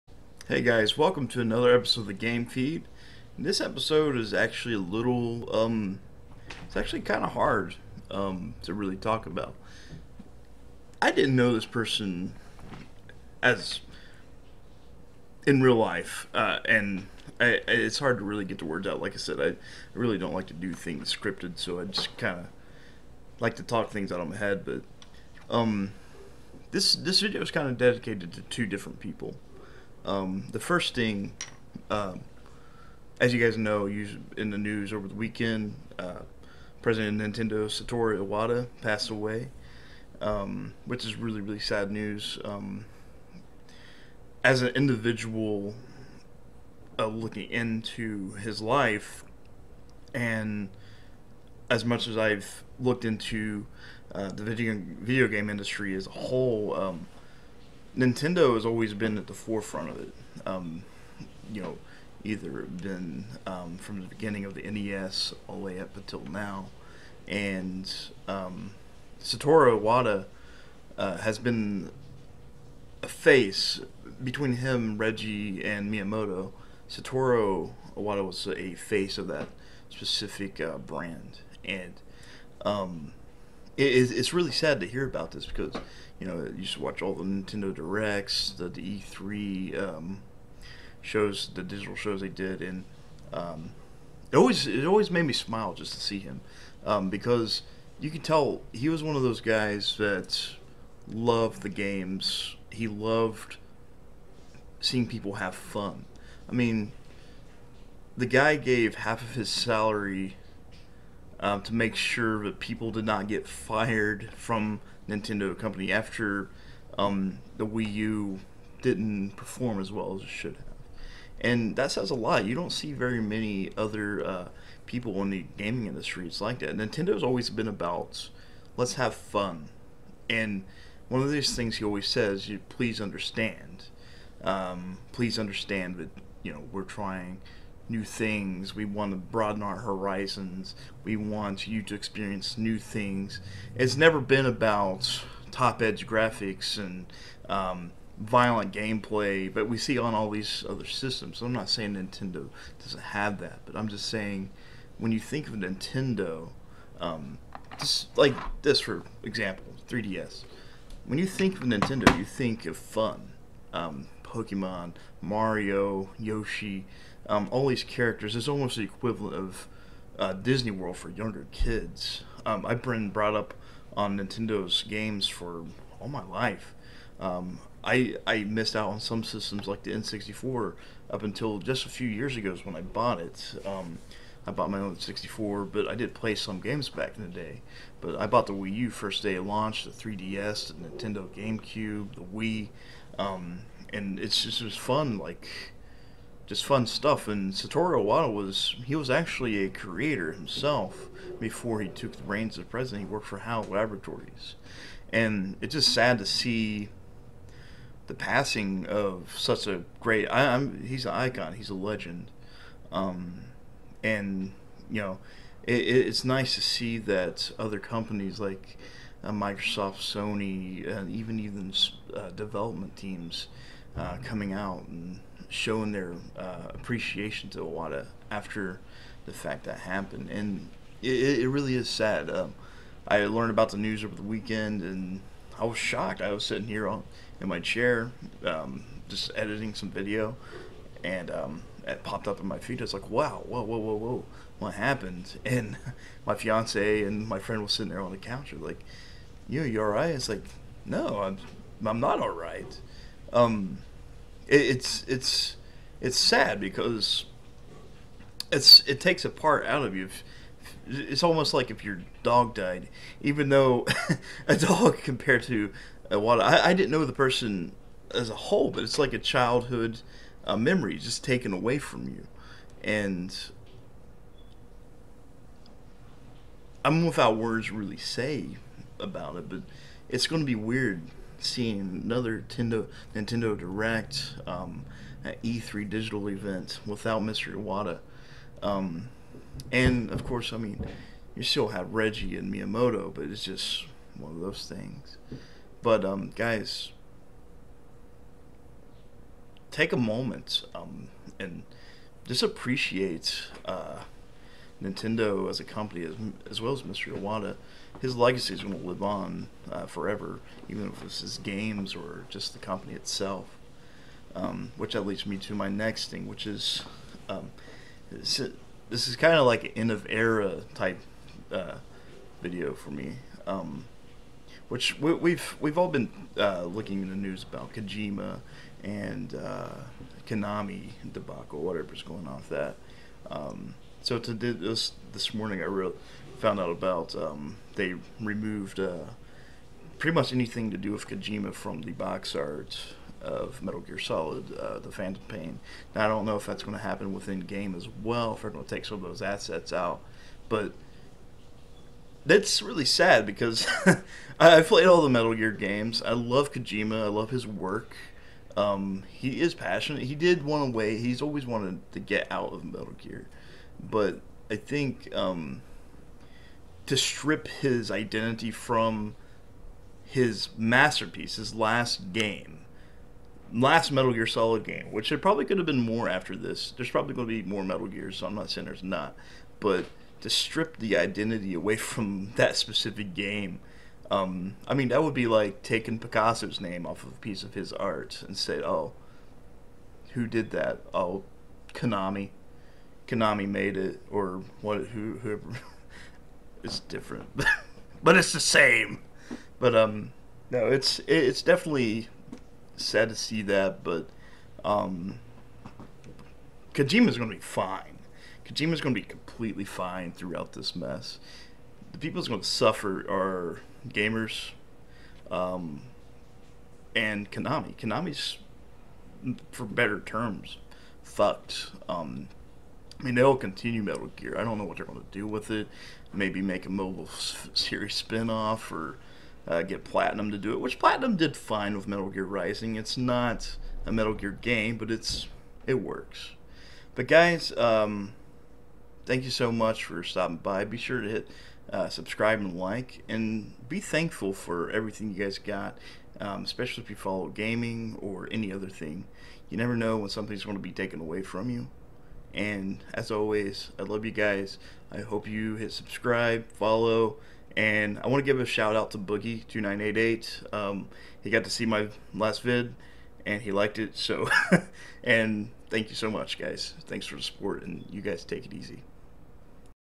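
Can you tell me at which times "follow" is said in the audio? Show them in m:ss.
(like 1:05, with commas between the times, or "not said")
7:26, 7:36.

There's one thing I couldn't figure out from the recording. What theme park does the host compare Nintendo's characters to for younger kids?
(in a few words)
Disney World.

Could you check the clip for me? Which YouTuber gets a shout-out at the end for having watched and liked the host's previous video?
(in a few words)
Boogie2988.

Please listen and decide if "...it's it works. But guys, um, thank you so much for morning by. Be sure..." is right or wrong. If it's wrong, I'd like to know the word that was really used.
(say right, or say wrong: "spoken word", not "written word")
wrong: "stopping", not "morning".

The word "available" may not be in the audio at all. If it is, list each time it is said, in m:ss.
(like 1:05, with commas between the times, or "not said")
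not said.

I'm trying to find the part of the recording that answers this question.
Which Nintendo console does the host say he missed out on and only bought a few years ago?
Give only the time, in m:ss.
2:59.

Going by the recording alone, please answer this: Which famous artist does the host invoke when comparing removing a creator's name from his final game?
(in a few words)
Picasso.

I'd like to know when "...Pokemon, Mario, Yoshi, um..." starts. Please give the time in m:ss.
2:44.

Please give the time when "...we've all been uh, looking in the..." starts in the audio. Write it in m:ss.
5:25.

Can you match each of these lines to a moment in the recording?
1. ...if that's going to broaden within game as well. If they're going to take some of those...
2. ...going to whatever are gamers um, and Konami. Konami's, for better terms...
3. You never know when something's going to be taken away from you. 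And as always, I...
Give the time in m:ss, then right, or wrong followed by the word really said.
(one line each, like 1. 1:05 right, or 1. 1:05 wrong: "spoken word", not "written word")
1. 5:46 wrong: "happen", not "broaden"
2. 6:52 wrong: "suffer", not "whatever"
3. 7:29 right.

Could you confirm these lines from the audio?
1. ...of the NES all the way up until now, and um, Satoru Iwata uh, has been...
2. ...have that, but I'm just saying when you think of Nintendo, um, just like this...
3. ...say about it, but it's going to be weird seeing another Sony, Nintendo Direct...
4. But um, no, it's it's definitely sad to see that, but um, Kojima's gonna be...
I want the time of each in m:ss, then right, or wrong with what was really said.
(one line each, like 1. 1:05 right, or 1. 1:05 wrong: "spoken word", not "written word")
1. 1:04 right
2. 2:33 right
3. 4:37 wrong: "Nintendo", not "Sony"
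4. 6:39 right.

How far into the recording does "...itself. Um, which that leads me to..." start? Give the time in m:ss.
5:12.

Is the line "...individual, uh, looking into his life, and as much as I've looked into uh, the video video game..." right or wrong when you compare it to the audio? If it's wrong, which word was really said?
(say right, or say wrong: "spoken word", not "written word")
right.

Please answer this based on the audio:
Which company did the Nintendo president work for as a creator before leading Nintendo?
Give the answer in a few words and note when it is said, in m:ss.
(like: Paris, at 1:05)
HAL Laboratories, at 3:23.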